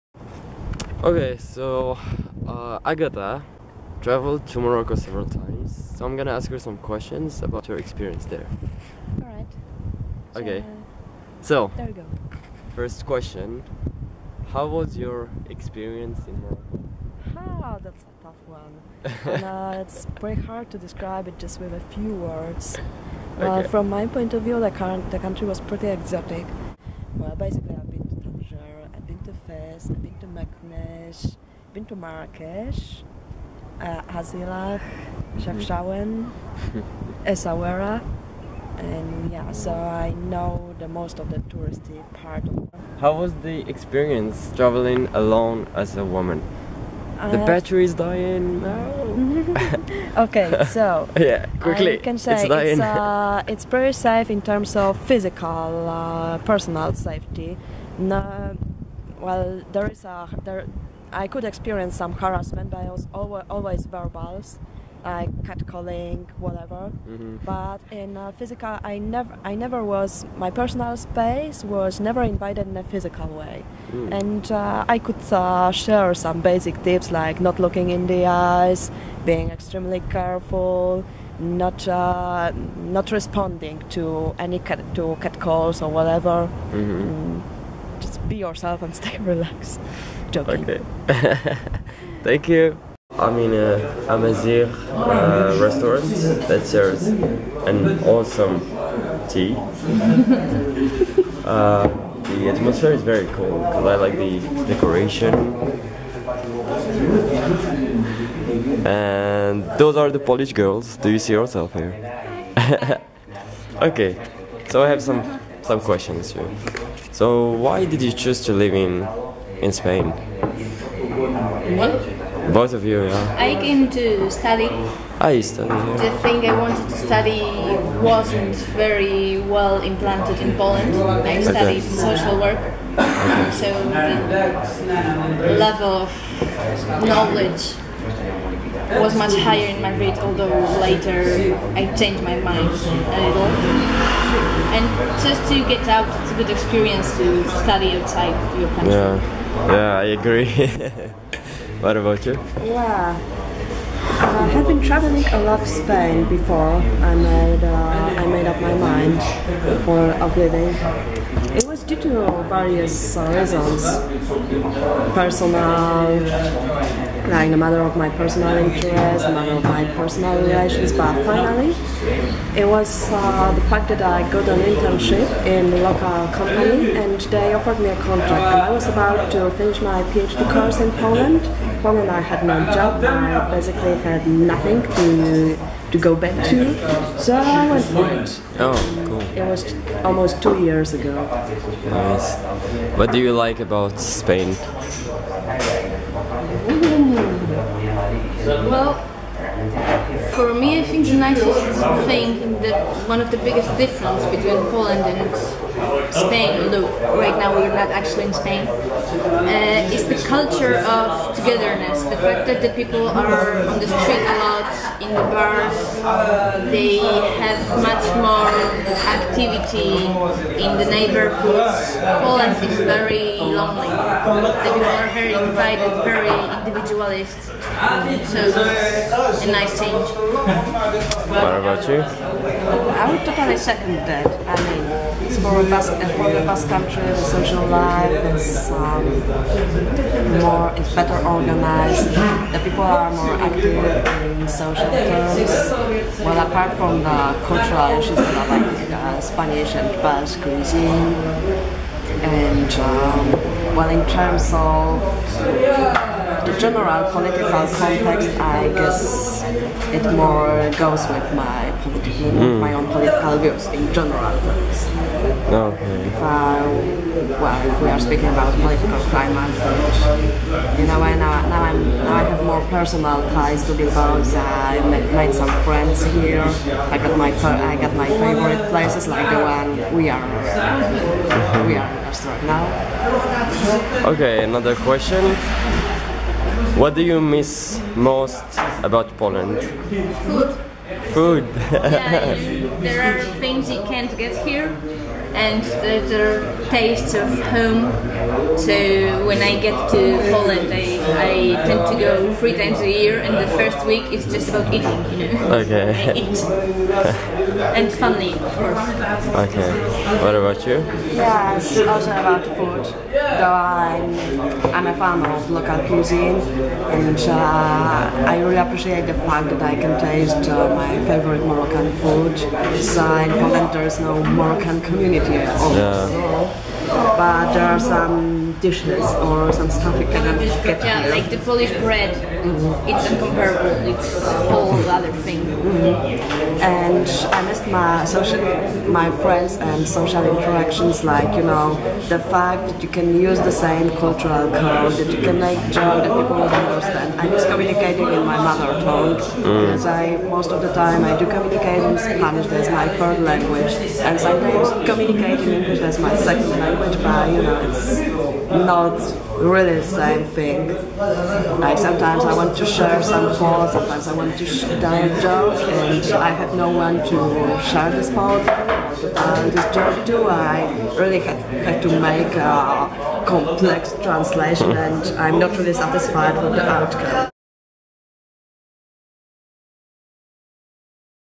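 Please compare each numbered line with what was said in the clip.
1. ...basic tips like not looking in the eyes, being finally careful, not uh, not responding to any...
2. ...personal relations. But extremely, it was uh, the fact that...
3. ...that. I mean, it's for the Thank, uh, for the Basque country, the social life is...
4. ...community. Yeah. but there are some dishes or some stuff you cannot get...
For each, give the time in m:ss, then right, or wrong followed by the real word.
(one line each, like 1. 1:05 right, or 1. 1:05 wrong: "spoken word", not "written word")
1. 1:16 wrong: "extremely", not "finally"
2. 2:49 wrong: "finally", not "extremely"
3. 3:54 wrong: "Basque", not "Thank"
4. 5:24 right.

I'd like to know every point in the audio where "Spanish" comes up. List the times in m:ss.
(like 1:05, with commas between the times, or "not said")
4:09, 5:51.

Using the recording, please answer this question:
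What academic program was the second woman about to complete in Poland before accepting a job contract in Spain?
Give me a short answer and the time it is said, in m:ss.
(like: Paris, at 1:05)
PhD, at 3:00.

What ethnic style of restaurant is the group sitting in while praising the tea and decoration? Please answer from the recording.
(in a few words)
Amazigh.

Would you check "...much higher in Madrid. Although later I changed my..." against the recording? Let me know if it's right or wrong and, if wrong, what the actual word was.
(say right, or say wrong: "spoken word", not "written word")
right.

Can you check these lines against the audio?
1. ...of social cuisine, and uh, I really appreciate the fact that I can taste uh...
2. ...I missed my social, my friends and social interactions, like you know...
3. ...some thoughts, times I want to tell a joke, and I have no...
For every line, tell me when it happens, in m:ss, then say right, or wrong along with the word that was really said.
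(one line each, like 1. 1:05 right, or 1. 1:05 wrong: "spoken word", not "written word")
1. 5:15 wrong: "local", not "social"
2. 5:37 right
3. 6:03 wrong: "sometimes", not "times".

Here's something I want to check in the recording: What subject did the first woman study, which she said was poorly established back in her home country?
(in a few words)
Social work.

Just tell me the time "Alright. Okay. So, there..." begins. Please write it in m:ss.
0:09.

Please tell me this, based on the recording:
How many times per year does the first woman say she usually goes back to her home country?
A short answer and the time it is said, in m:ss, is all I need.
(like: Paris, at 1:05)
3, at 5:02.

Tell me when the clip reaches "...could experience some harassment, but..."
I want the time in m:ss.
1:01.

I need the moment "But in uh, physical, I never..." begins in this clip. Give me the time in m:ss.
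1:07.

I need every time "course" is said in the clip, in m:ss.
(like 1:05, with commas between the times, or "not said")
3:00, 5:08.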